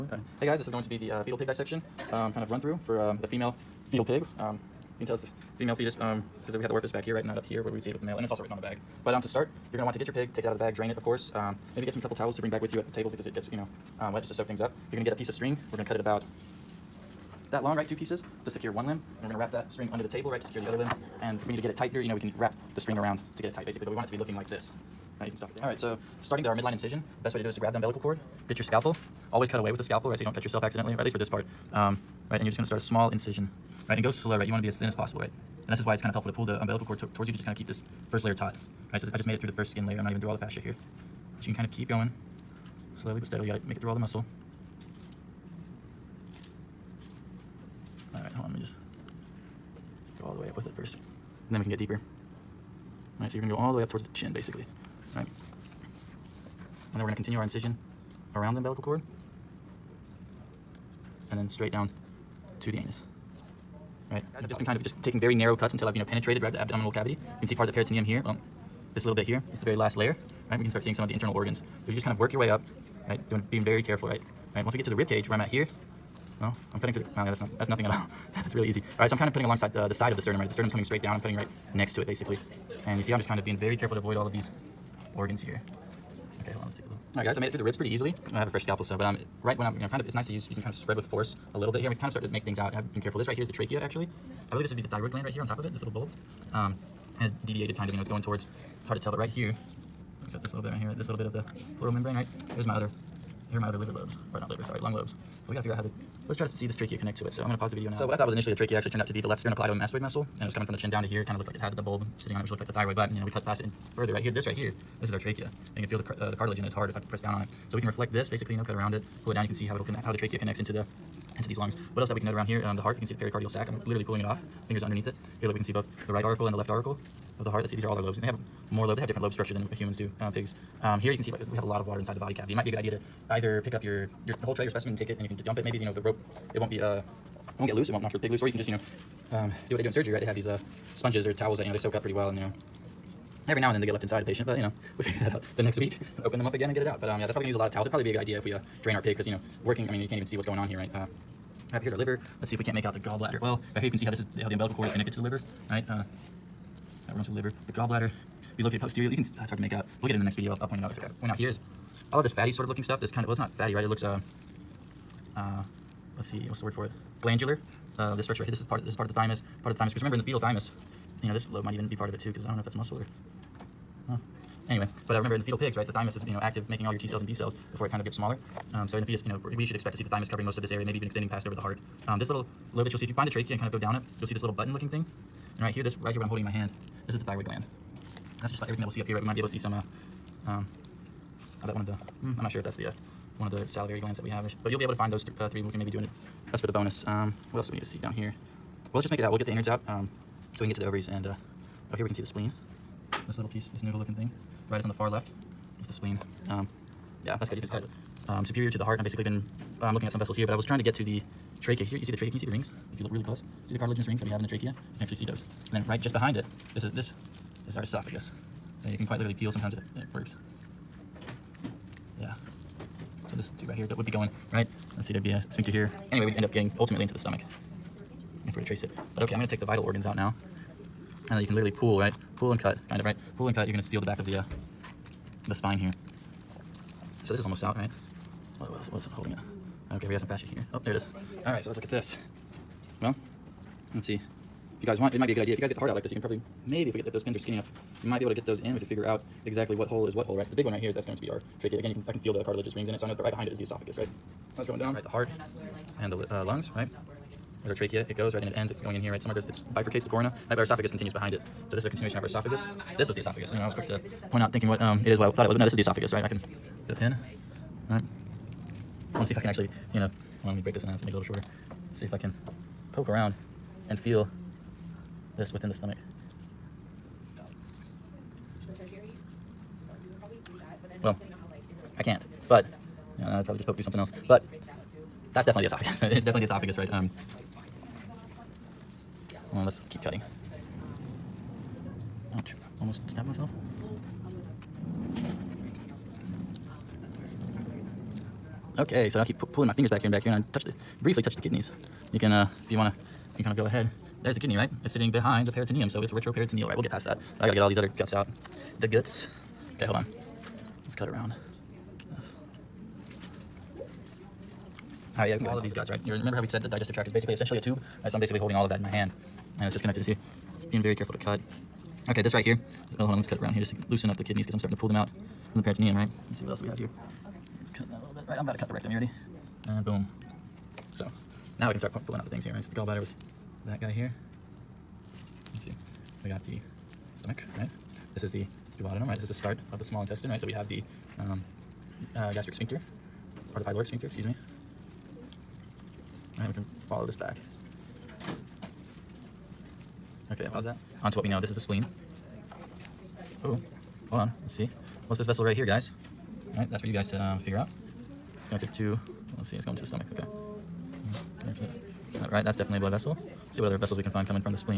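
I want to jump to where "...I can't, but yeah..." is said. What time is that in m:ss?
4:41.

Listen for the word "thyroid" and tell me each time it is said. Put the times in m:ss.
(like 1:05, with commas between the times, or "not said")
1:34, 1:52, 3:07.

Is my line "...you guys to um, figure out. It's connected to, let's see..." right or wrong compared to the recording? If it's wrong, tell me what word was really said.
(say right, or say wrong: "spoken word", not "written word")
right.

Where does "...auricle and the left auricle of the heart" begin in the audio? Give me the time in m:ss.
2:06.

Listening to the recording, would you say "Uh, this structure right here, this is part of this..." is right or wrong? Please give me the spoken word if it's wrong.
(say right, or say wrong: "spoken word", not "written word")
right.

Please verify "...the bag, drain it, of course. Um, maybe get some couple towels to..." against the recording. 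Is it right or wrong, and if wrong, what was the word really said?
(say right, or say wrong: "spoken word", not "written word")
right.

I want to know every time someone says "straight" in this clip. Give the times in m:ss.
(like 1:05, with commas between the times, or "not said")
1:01, 1:20.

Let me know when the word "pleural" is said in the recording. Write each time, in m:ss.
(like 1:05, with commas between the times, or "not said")
1:41.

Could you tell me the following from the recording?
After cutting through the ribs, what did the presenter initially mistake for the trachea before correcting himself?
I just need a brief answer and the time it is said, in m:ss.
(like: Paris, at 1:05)
left sternocleidomastoid muscle, at 1:49.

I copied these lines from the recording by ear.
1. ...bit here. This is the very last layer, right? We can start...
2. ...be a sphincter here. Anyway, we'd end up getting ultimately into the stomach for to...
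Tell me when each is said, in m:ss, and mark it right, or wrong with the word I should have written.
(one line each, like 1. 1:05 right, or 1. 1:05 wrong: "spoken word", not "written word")
1. 1:09 right
2. 3:45 right.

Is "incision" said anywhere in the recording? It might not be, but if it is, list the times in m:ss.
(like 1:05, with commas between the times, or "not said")
0:26, 0:33, 0:57.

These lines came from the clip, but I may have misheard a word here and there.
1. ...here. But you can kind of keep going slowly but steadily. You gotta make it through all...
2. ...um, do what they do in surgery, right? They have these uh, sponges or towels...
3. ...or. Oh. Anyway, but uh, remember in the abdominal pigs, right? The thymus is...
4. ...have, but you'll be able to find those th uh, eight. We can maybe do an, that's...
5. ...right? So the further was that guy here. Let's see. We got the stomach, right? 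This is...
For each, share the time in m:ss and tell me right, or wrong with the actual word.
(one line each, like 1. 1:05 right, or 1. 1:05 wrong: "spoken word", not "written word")
1. 0:40 right
2. 2:19 right
3. 2:52 wrong: "fetal", not "abdominal"
4. 3:14 wrong: "three", not "eight"
5. 5:32 wrong: "gallbladder", not "further".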